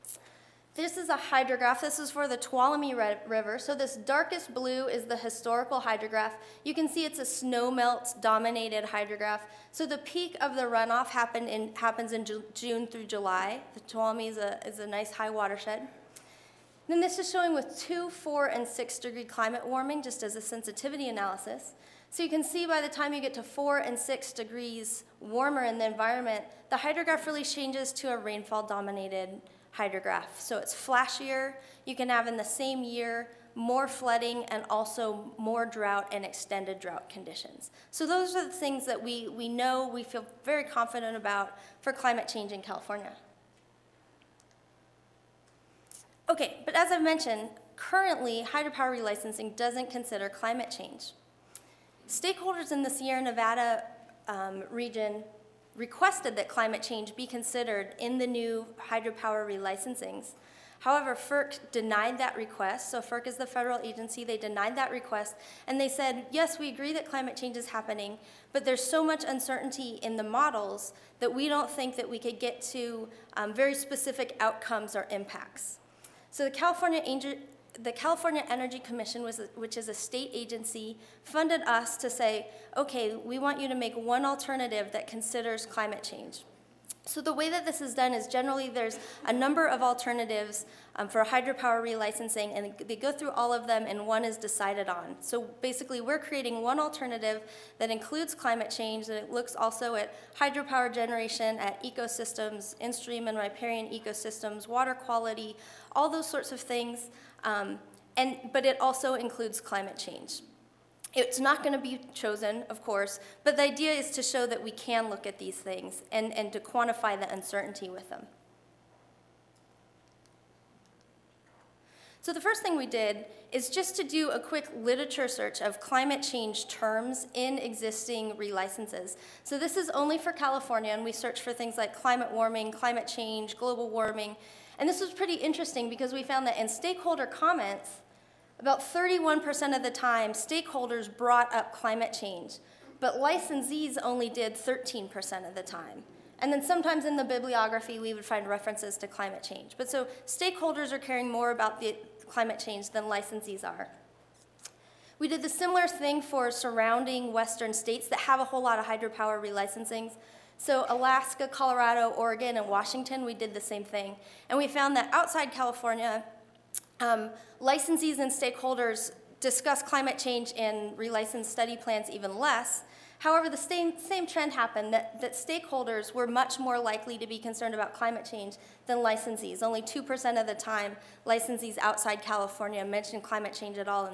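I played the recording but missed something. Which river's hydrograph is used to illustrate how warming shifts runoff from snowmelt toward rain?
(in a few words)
Tuolumne River.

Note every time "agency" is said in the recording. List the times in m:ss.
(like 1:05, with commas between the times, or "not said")
1:03, 1:20.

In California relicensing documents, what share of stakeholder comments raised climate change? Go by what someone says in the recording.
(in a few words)
31%.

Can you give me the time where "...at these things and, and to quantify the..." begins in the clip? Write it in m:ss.
1:55.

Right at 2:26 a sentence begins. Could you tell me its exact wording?
And then sometimes in the bibliography, we would find references to climate change.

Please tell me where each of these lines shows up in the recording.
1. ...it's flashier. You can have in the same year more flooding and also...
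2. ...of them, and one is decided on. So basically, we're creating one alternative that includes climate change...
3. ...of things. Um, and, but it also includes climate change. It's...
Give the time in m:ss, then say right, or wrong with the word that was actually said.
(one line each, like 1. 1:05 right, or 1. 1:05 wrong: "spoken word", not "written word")
1. 0:30 right
2. 1:33 right
3. 1:46 right.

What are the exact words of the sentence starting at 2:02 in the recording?
So the first thing we did is just to do a quick literature search of climate change terms in existing relicenses.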